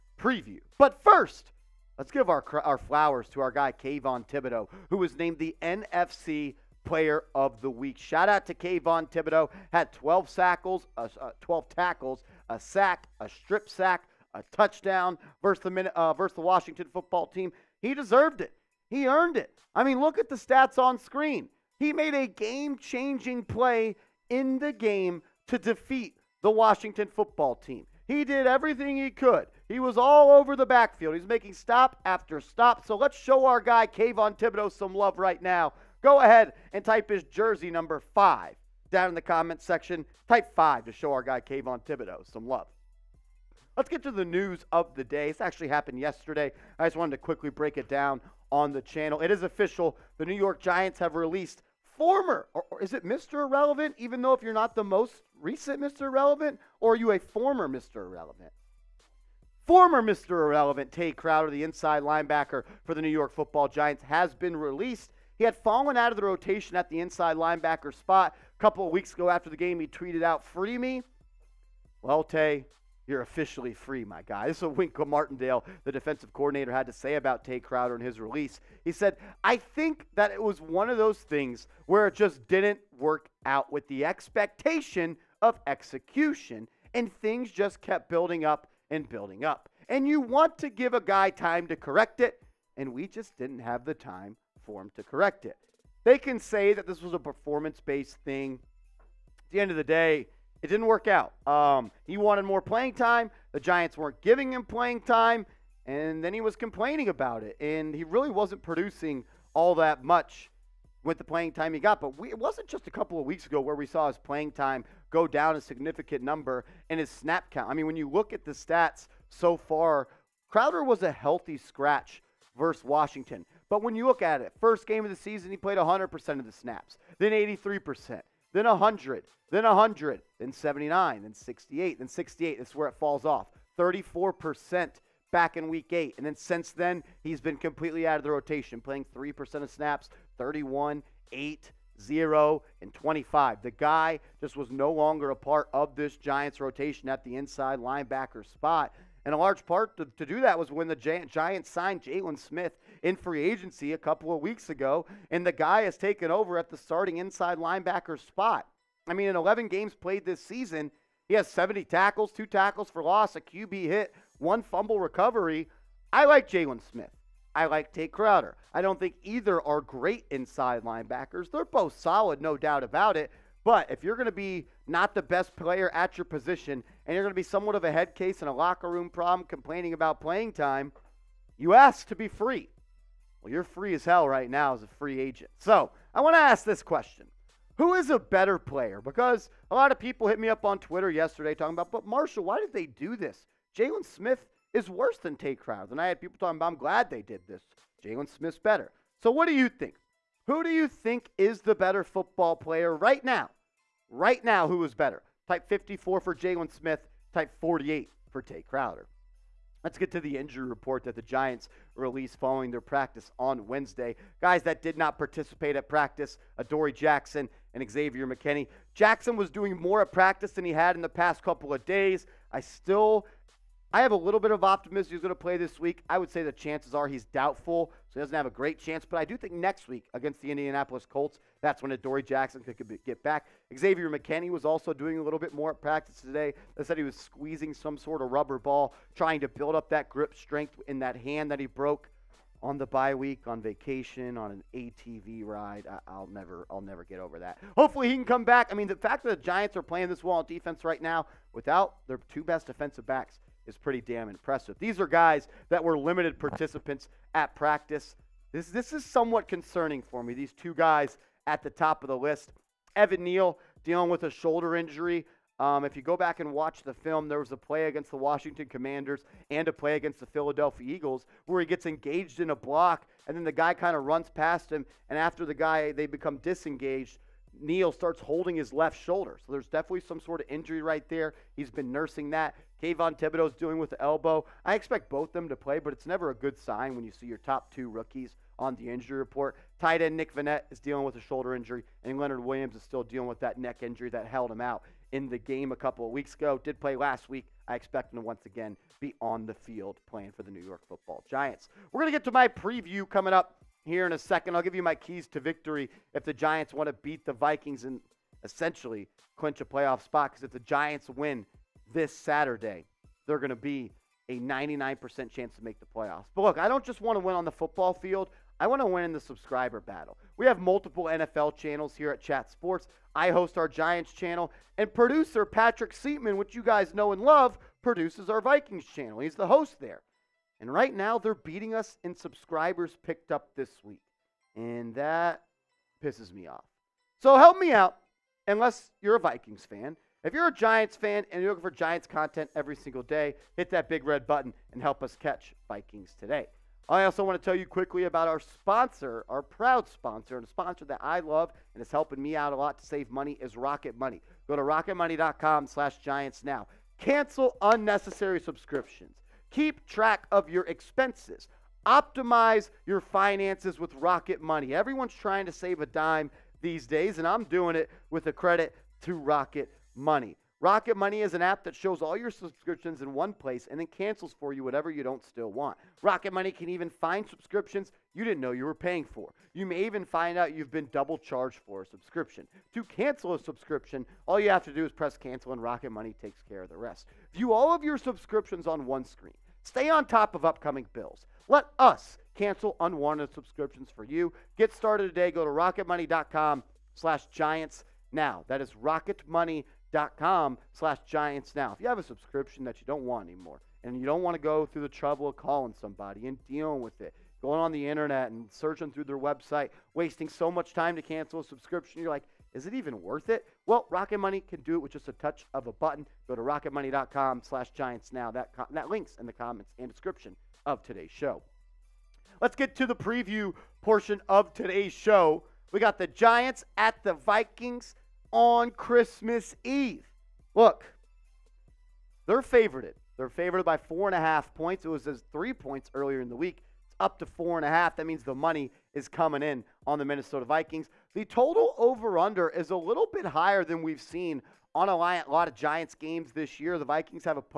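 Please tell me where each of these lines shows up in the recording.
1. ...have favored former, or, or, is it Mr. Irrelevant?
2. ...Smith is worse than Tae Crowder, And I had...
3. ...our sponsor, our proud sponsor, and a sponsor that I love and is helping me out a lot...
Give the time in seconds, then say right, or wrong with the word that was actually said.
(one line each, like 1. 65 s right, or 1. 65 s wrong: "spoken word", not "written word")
1. 50 s wrong: "released", not "favored"
2. 194 s right
3. 348 s right.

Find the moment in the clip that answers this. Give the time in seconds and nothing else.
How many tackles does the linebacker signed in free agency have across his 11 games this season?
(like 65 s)
161 s.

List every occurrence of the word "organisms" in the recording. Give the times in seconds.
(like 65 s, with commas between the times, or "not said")
not said.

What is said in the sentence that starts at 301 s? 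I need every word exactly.
We're going to get to my preview coming up here in a second.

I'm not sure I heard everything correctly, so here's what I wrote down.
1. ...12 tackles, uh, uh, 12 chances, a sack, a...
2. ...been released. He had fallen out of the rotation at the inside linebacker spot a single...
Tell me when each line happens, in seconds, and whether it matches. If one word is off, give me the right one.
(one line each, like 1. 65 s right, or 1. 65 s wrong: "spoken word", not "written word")
1. 9 s wrong: "tackles", not "chances"
2. 64 s wrong: "couple", not "single".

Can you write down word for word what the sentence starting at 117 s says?
I mean, when you look at the stats so far, Crowder was a healthy scratch versus Washington.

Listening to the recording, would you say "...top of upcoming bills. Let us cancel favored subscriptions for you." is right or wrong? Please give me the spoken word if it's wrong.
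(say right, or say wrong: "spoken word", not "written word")
wrong: "unwanted", not "favored".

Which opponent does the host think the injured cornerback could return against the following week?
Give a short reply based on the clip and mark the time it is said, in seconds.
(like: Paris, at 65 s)
Indianapolis Colts, at 230 s.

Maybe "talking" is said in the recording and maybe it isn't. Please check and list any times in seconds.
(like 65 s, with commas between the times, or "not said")
191 s, 196 s.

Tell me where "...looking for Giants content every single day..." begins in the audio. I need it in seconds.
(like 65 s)
341 s.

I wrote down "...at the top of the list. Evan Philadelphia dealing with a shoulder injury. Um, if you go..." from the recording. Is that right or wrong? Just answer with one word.
wrong.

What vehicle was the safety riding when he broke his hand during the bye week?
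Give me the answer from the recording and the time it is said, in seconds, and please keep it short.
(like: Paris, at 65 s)
ATV, at 244 s.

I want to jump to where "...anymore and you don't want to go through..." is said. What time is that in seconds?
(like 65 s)
403 s.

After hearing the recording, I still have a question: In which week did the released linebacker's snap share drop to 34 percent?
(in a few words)
Week 8.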